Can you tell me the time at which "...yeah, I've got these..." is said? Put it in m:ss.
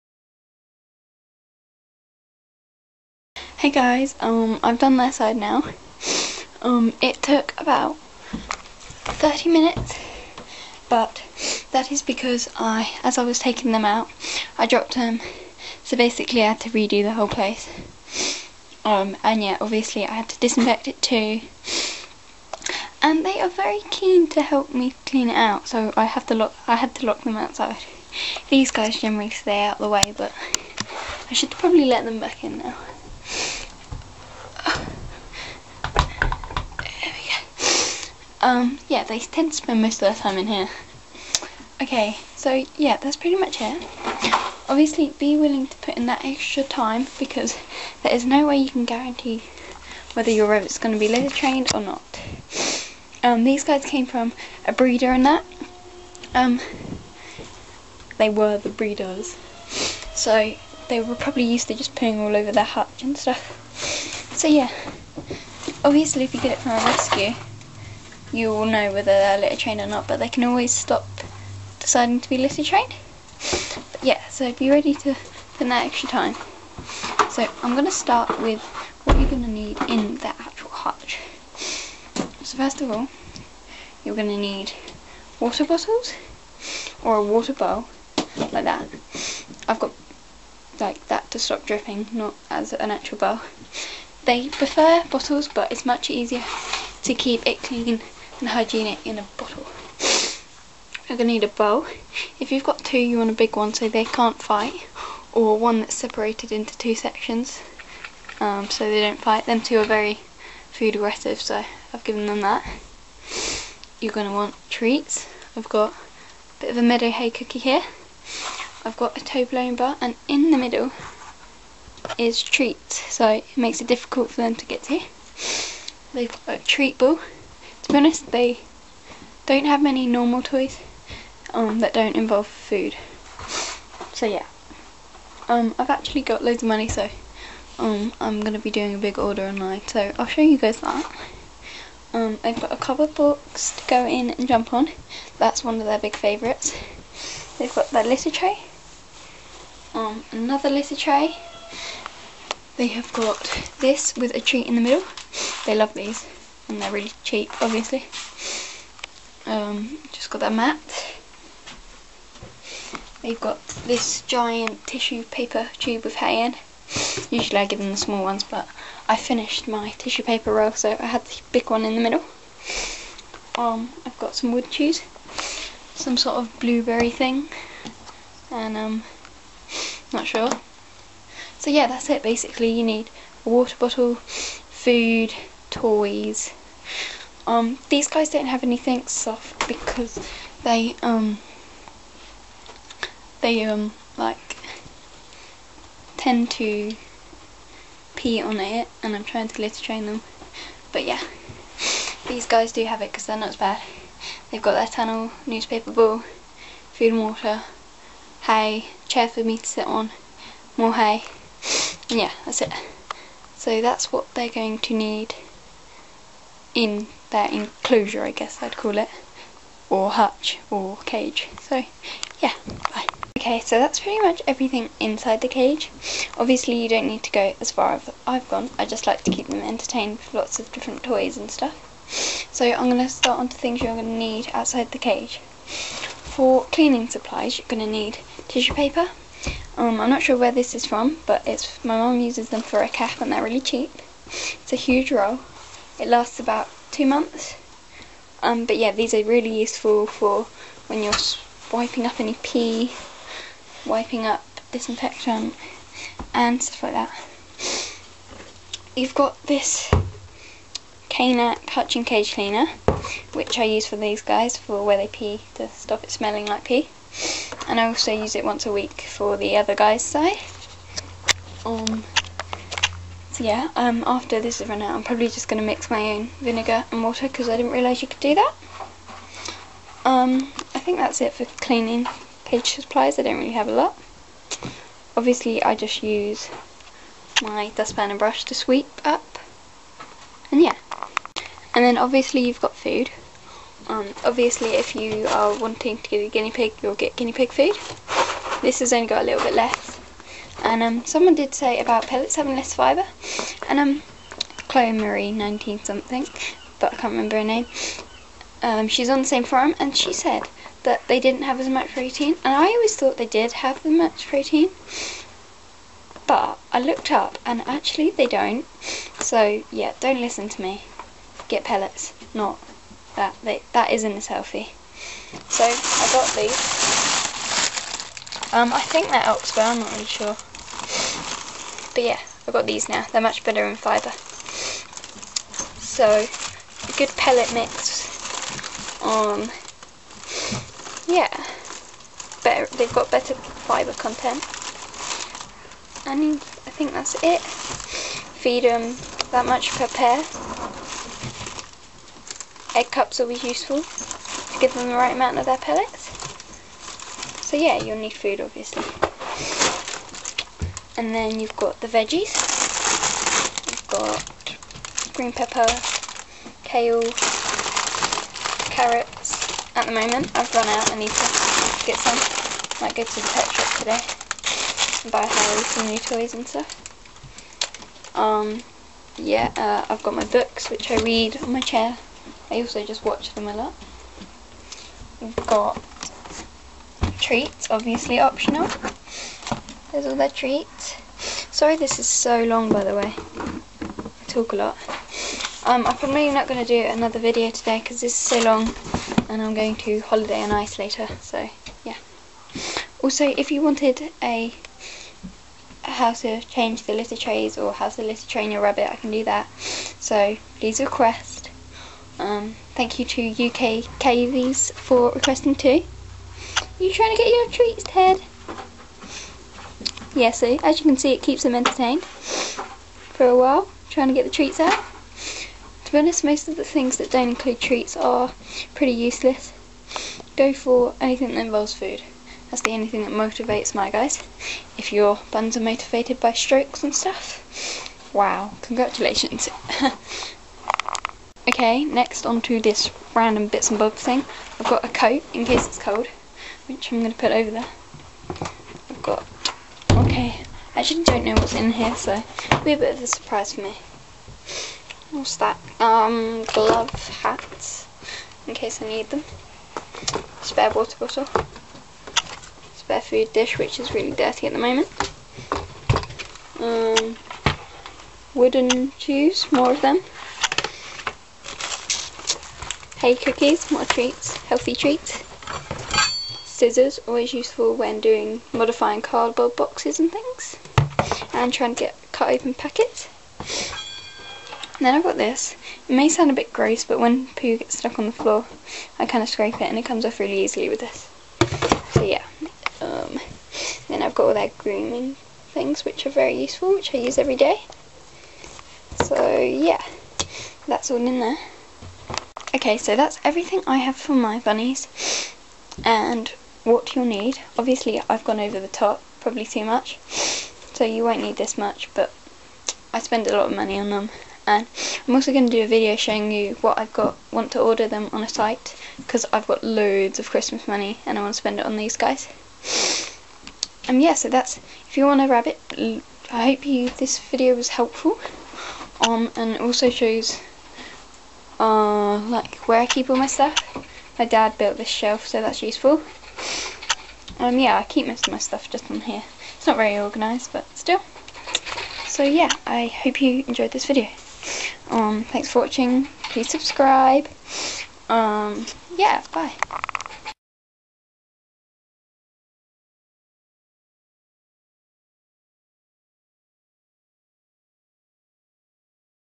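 5:32.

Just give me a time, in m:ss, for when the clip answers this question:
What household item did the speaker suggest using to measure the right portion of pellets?
5:52.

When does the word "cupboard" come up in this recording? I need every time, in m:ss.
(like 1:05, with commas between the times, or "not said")
2:22.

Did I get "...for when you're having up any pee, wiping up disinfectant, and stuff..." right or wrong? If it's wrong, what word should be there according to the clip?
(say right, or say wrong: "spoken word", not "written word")
wrong: "wiping", not "having".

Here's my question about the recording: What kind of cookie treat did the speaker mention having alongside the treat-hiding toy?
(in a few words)
Meadow hay cookie.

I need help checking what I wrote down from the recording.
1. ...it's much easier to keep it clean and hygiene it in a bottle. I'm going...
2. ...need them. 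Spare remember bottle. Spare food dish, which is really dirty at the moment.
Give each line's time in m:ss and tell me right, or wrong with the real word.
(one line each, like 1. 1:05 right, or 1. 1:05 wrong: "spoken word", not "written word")
1. 1:35 right
2. 7:38 wrong: "water", not "remember".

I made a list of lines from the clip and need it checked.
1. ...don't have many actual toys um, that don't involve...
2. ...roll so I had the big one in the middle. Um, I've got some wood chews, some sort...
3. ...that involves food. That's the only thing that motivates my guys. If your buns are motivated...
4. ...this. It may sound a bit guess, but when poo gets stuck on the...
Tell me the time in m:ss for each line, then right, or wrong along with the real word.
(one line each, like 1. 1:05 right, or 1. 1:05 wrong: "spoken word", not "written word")
1. 2:09 wrong: "normal", not "actual"
2. 2:50 right
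3. 7:11 right
4. 8:05 wrong: "gross", not "guess".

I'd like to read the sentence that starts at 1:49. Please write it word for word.
Them two are very food aggressive, so I've given them that.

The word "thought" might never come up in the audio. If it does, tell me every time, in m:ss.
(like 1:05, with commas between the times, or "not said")
5:12.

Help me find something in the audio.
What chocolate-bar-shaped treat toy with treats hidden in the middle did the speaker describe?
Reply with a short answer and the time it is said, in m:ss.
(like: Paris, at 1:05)
Toblerone bar, at 1:59.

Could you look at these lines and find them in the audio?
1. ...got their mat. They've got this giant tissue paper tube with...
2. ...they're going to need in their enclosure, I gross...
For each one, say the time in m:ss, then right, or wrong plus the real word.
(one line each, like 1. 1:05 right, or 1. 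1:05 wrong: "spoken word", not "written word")
1. 2:40 right
2. 3:34 wrong: "guess", not "gross".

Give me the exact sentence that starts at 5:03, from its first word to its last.
And um, Chloe Marie, 19 something, but I can't remember her name.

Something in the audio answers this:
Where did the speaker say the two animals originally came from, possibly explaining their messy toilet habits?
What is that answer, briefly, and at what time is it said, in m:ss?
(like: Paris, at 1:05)
A breeder, at 0:54.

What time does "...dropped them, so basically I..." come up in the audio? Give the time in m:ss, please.
0:14.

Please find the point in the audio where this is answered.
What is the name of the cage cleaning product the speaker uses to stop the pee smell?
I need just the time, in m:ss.
4:21.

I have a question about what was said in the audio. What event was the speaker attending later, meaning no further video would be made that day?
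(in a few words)
Holiday on Ice.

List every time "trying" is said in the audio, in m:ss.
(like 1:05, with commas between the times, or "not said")
3:19, 6:56, 7:03, 8:01.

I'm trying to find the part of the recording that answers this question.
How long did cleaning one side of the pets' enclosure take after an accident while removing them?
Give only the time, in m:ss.
0:09.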